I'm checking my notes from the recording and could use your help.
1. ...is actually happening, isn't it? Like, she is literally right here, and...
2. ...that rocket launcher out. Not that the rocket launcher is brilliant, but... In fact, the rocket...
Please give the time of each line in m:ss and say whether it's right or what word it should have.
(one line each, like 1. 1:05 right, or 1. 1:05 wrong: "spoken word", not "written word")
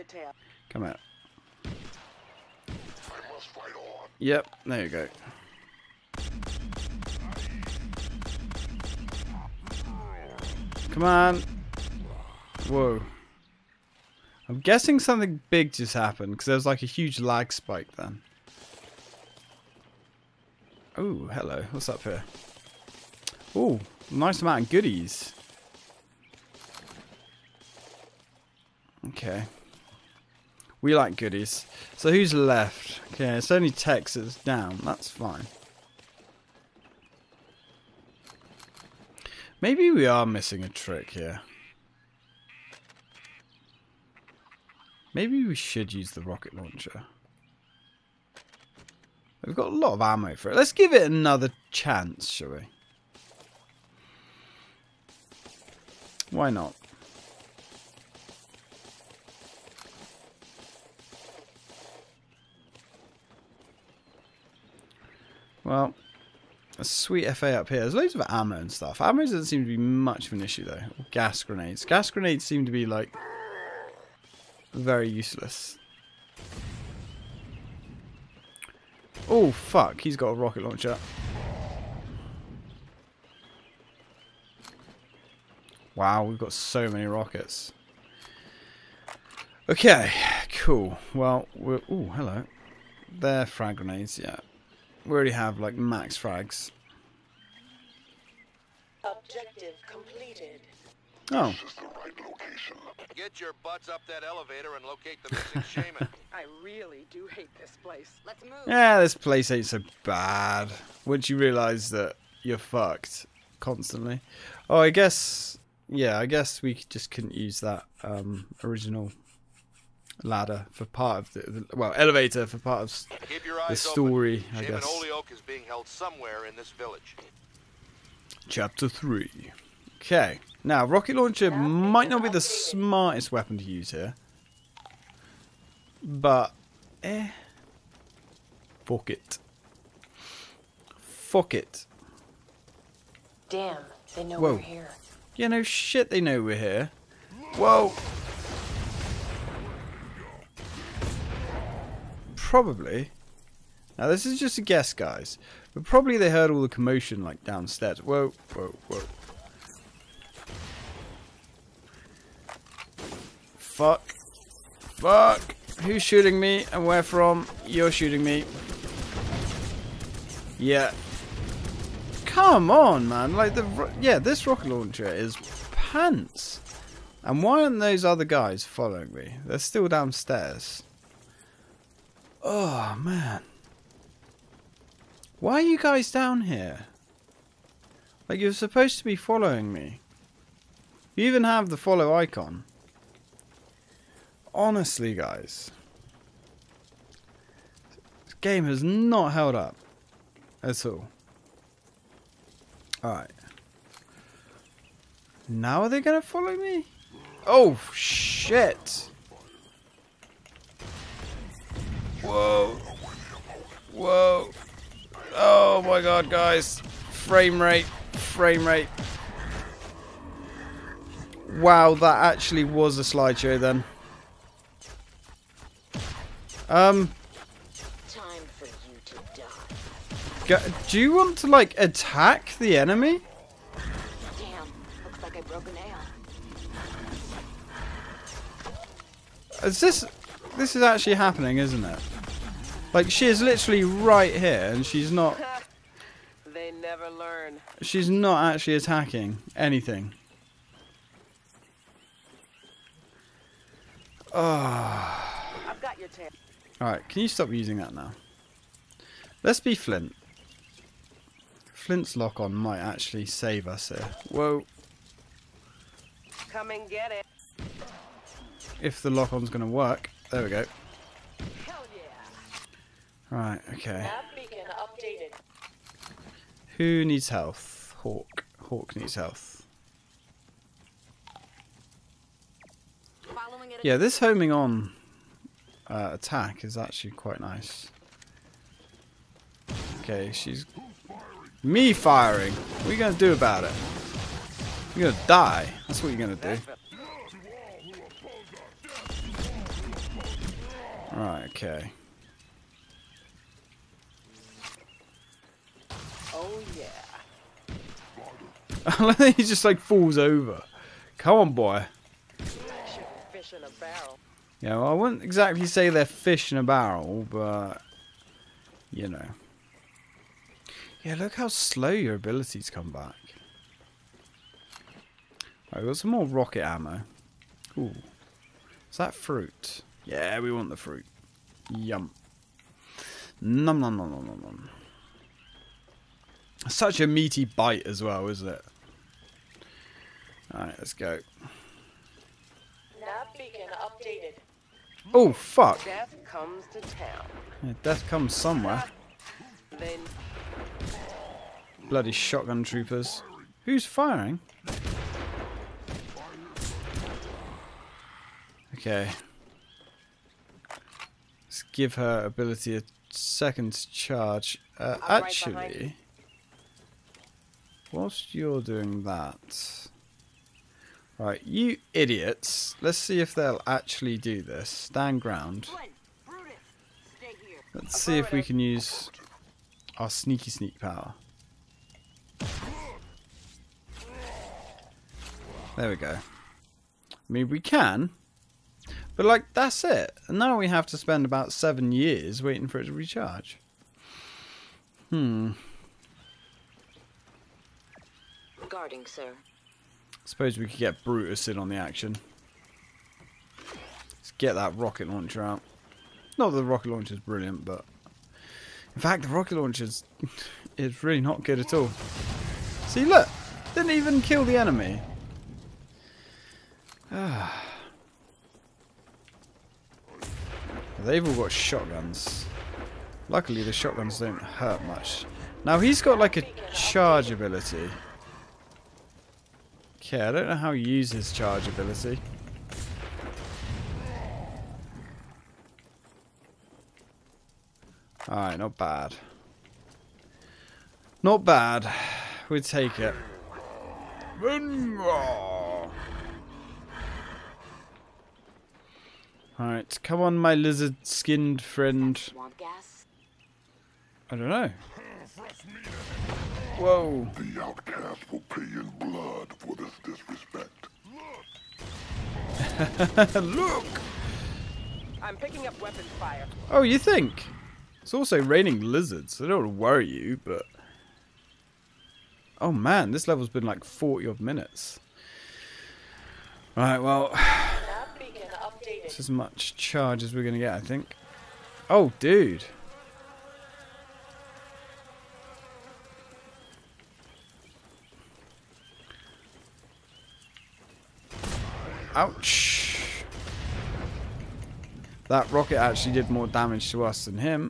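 1. 4:00 right
2. 6:44 right.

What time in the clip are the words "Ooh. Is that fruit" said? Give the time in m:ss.
5:27.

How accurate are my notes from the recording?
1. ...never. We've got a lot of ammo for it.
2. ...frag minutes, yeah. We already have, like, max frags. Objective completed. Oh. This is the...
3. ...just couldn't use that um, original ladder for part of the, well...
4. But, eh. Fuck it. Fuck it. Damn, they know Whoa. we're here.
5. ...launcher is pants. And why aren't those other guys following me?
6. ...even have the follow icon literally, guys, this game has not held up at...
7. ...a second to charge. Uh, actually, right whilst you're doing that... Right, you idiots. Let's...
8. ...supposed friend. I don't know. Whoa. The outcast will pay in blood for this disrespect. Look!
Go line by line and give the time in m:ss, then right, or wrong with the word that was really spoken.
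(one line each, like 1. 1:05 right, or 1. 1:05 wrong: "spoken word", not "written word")
1. 0:46 wrong: "launcher", not "never"
2. 1:33 wrong: "grenades", not "minutes"
3. 1:56 right
4. 2:16 right
5. 2:54 right
6. 3:11 wrong: "honestly", not "literally"
7. 6:02 right
8. 7:31 wrong: "skinned", not "supposed".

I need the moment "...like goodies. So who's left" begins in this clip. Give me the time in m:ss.
0:30.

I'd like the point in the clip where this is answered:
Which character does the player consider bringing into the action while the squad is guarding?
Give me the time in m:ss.
6:41.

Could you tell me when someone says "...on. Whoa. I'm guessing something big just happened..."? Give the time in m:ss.
0:11.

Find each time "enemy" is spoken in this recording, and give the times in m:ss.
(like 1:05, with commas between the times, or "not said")
3:52, 6:54.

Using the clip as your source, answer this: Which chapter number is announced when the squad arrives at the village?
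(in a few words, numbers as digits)
3.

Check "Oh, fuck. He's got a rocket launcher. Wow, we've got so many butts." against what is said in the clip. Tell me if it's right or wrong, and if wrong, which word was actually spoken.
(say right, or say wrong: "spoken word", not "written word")
wrong: "rockets", not "butts".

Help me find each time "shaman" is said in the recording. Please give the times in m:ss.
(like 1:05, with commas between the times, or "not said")
1:45, 2:04.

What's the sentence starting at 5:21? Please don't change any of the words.
Yeah, look how slow your abilities come back.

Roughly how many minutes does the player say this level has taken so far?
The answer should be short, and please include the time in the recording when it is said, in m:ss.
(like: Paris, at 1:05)
40, at 7:53.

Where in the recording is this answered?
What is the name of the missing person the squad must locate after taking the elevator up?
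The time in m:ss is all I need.
2:04.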